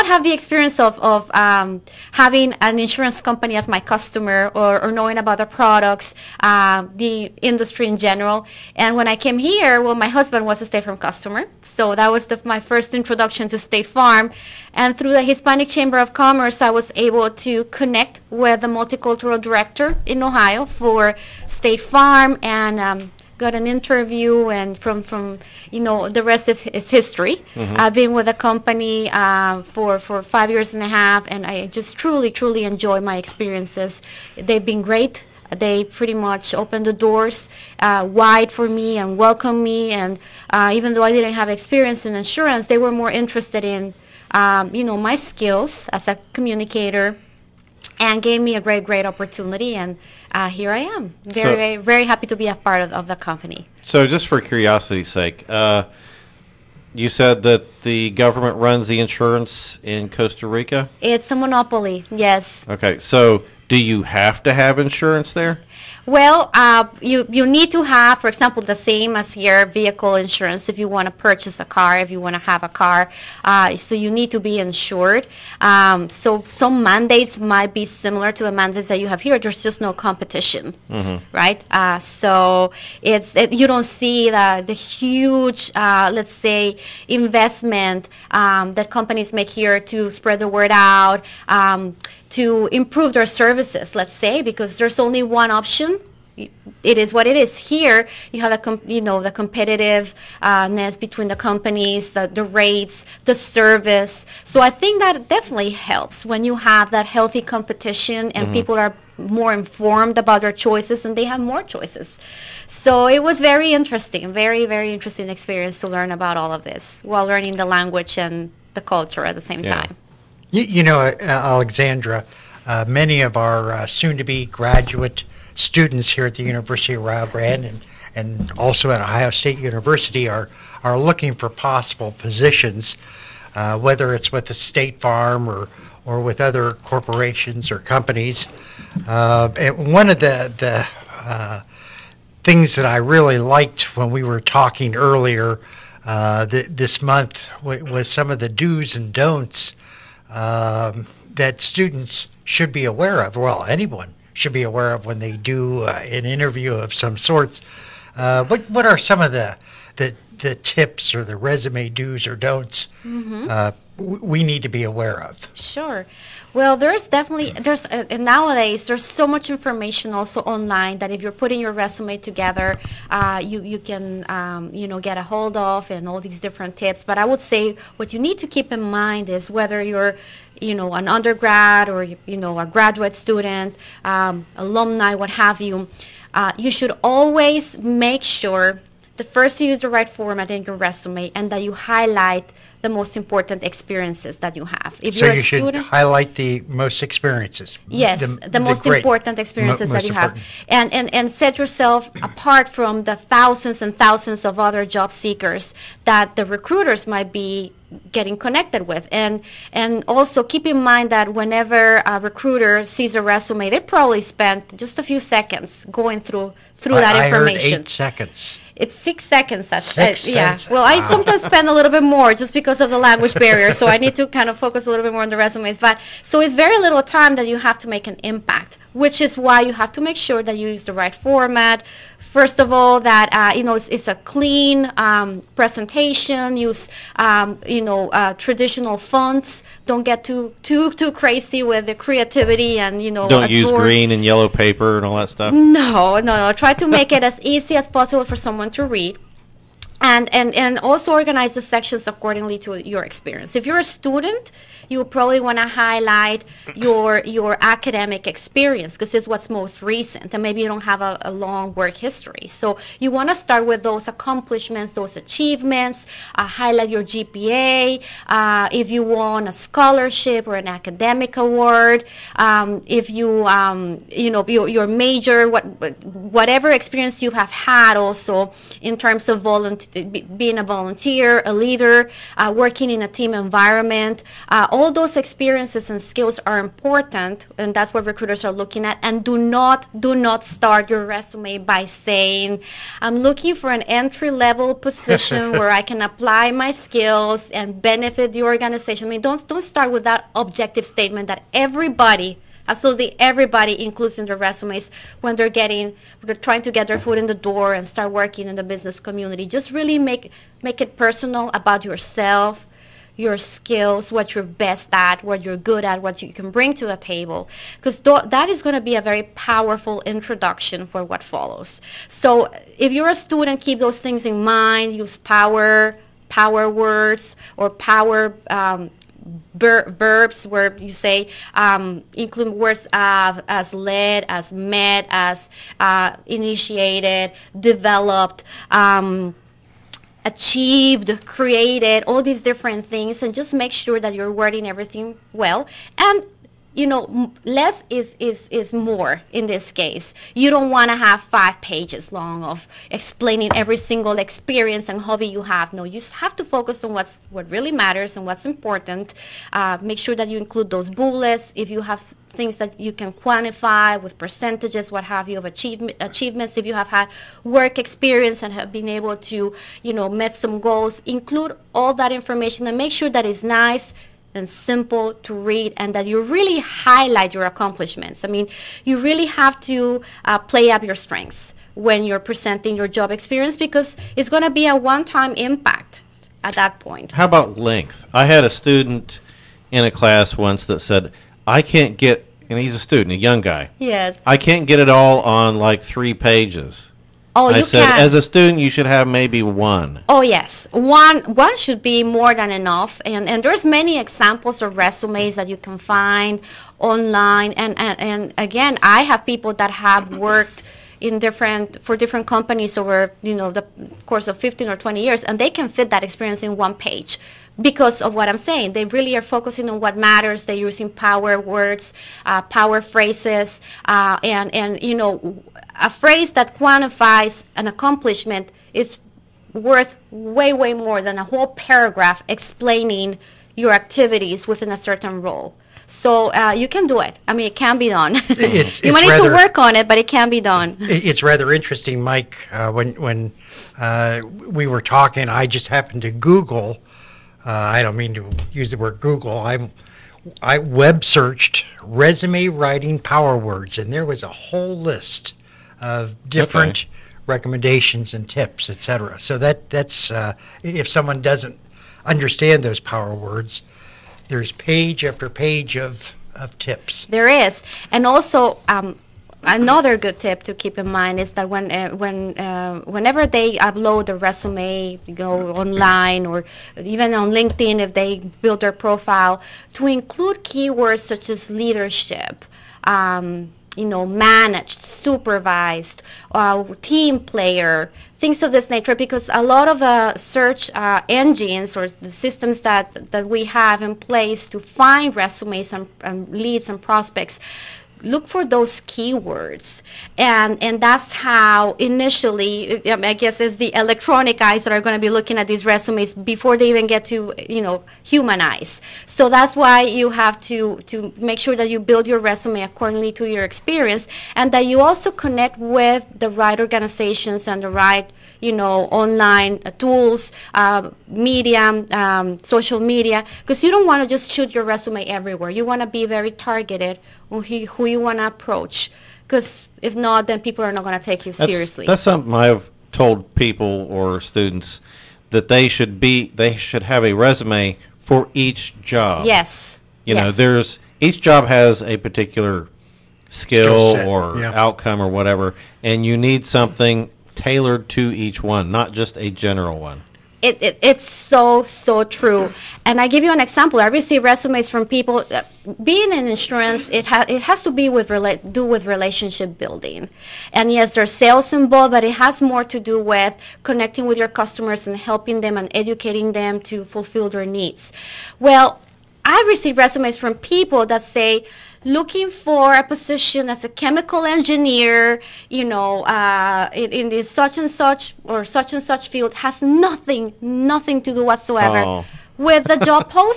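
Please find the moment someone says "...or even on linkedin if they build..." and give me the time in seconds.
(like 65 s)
476 s.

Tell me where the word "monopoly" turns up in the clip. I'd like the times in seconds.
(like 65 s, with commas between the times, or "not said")
61 s.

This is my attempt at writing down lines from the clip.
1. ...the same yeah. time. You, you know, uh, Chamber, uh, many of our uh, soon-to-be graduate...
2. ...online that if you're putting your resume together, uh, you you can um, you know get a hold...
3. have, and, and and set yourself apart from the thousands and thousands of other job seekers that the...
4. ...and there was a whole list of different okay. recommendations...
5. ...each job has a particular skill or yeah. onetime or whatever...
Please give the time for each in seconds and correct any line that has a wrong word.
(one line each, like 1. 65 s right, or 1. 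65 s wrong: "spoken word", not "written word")
1. 119 s wrong: "Alexandra", not "Chamber"
2. 170 s right
3. 200 s right
4. 453 s right
5. 541 s wrong: "outcome", not "onetime".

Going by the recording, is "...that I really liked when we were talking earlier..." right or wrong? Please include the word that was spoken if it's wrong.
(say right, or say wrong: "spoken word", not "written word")
right.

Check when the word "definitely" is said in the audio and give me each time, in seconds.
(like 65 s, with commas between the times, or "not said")
105 s, 167 s.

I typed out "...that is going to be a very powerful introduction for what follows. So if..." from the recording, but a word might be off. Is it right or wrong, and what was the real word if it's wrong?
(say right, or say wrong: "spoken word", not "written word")
right.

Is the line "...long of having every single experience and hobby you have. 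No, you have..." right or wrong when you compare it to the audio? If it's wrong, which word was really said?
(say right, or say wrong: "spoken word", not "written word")
wrong: "explaining", not "having".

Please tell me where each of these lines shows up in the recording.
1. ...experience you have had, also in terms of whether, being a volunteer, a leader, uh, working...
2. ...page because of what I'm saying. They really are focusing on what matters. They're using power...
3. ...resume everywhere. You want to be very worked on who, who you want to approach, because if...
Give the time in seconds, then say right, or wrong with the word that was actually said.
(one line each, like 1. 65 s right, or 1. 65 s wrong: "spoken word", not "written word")
1. 276 s wrong: "volunteer", not "whether"
2. 416 s right
3. 524 s wrong: "targeted", not "worked".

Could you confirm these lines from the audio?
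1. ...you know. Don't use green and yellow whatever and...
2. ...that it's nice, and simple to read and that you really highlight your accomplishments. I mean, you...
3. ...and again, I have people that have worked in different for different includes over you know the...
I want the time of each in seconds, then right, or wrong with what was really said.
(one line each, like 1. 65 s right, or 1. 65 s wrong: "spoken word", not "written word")
1. 243 s wrong: "paper", not "whatever"
2. 373 s right
3. 408 s wrong: "companies", not "includes".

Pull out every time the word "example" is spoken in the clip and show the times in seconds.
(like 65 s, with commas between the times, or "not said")
68 s, 403 s, 553 s.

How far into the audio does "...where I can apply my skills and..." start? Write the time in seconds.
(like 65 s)
295 s.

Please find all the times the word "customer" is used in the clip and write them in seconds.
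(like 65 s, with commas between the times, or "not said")
3 s, 10 s, 564 s.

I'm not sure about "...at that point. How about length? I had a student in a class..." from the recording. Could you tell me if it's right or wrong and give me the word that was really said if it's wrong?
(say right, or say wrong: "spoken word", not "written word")
right.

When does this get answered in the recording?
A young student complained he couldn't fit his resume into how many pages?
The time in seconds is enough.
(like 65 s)
395 s.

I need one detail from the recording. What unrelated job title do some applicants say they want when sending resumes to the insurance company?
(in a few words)
Chemical engineer.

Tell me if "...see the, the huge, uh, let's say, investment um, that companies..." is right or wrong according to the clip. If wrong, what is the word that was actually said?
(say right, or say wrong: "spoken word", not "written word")
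right.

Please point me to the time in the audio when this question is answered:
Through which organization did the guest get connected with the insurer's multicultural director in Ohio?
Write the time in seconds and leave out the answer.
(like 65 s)
15 s.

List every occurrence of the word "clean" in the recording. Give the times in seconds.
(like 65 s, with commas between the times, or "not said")
234 s.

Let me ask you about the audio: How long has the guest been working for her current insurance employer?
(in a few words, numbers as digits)
5 and a half years.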